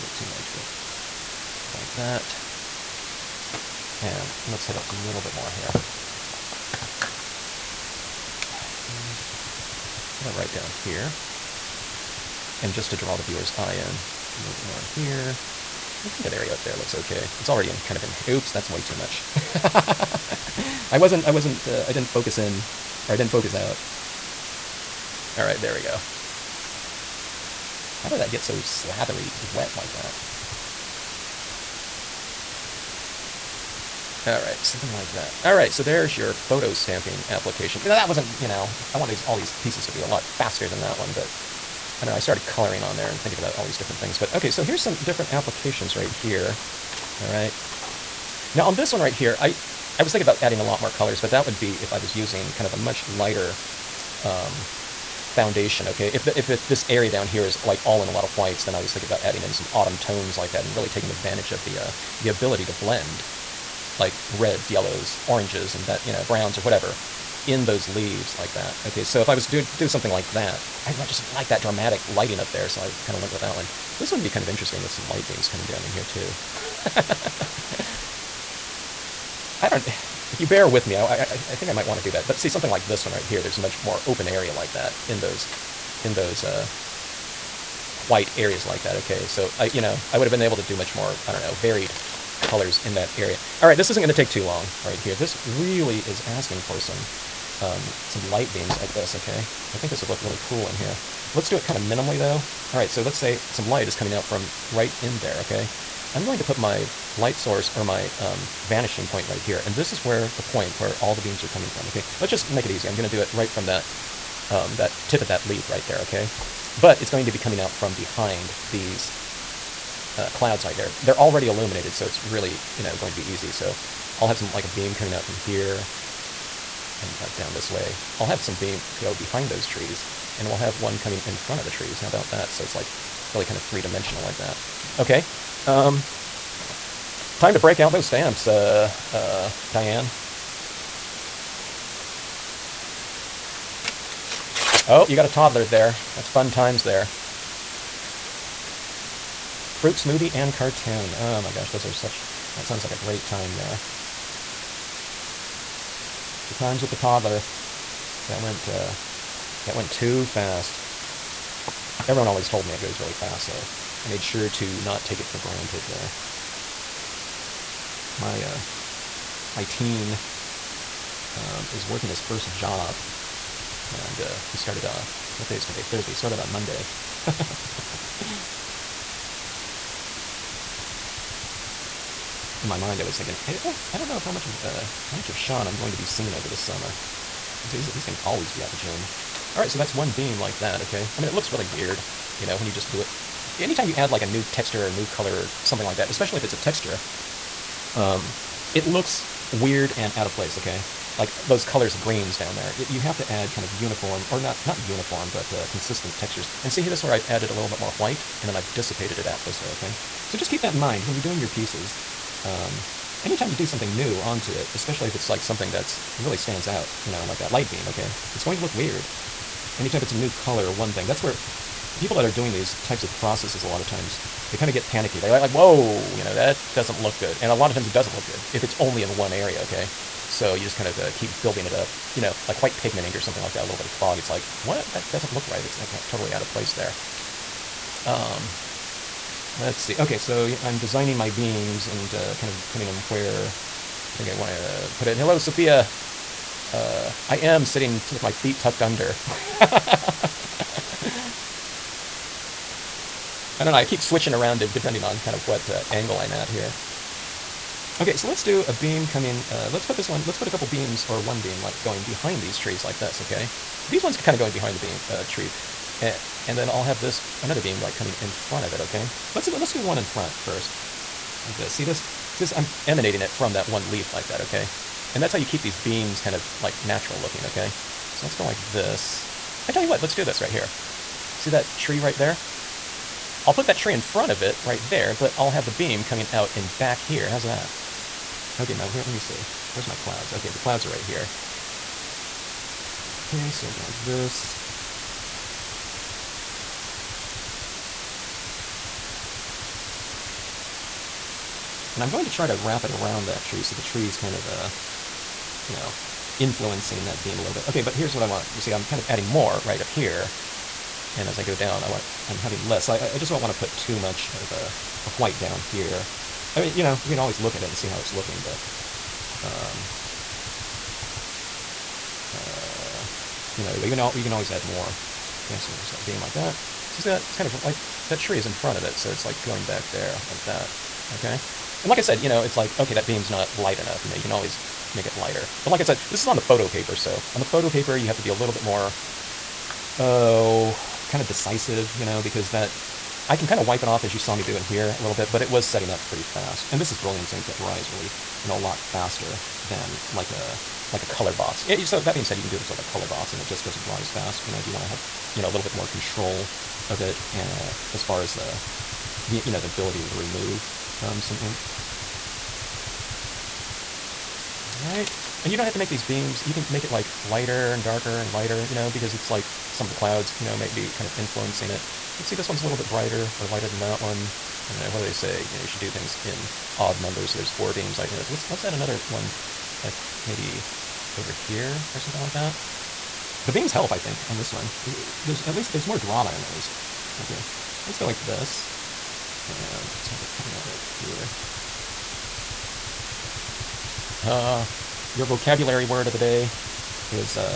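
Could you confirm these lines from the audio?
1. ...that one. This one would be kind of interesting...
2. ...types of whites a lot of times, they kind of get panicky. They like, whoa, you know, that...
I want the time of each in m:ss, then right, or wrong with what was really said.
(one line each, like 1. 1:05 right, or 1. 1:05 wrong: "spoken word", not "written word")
1. 1:13 right
2. 3:42 wrong: "processes", not "whites".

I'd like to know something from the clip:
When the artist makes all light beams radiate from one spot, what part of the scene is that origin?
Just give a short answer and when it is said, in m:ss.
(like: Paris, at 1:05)
tip of that leaf, at 1:55.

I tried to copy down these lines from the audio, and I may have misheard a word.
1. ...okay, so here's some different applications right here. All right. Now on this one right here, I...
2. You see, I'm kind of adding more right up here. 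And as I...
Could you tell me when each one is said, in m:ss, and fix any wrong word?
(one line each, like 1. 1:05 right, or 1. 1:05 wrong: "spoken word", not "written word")
1. 0:44 right
2. 5:08 right.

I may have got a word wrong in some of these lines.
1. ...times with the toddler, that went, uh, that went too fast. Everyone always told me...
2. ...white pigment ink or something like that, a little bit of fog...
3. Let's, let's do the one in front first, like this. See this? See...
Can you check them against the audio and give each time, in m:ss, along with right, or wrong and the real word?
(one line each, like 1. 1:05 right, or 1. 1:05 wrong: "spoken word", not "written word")
1. 2:36 right
2. 3:52 right
3. 4:29 right.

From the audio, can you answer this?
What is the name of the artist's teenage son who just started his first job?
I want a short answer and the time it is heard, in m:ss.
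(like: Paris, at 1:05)
Sean, at 3:05.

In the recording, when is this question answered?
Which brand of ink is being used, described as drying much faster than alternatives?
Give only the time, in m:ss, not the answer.
5:46.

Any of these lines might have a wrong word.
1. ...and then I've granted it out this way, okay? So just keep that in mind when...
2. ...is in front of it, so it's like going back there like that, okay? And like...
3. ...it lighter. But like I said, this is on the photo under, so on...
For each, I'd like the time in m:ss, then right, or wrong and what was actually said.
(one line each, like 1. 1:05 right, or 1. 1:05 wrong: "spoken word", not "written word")
1. 3:28 wrong: "dissipated", not "granted"
2. 5:28 right
3. 5:35 wrong: "paper", not "under".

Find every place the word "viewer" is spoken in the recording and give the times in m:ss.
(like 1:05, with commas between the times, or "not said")
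0:13.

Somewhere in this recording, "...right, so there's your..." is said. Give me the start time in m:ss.
0:35.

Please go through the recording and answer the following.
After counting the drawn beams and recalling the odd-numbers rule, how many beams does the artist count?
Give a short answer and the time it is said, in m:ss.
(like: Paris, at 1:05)
4, at 6:17.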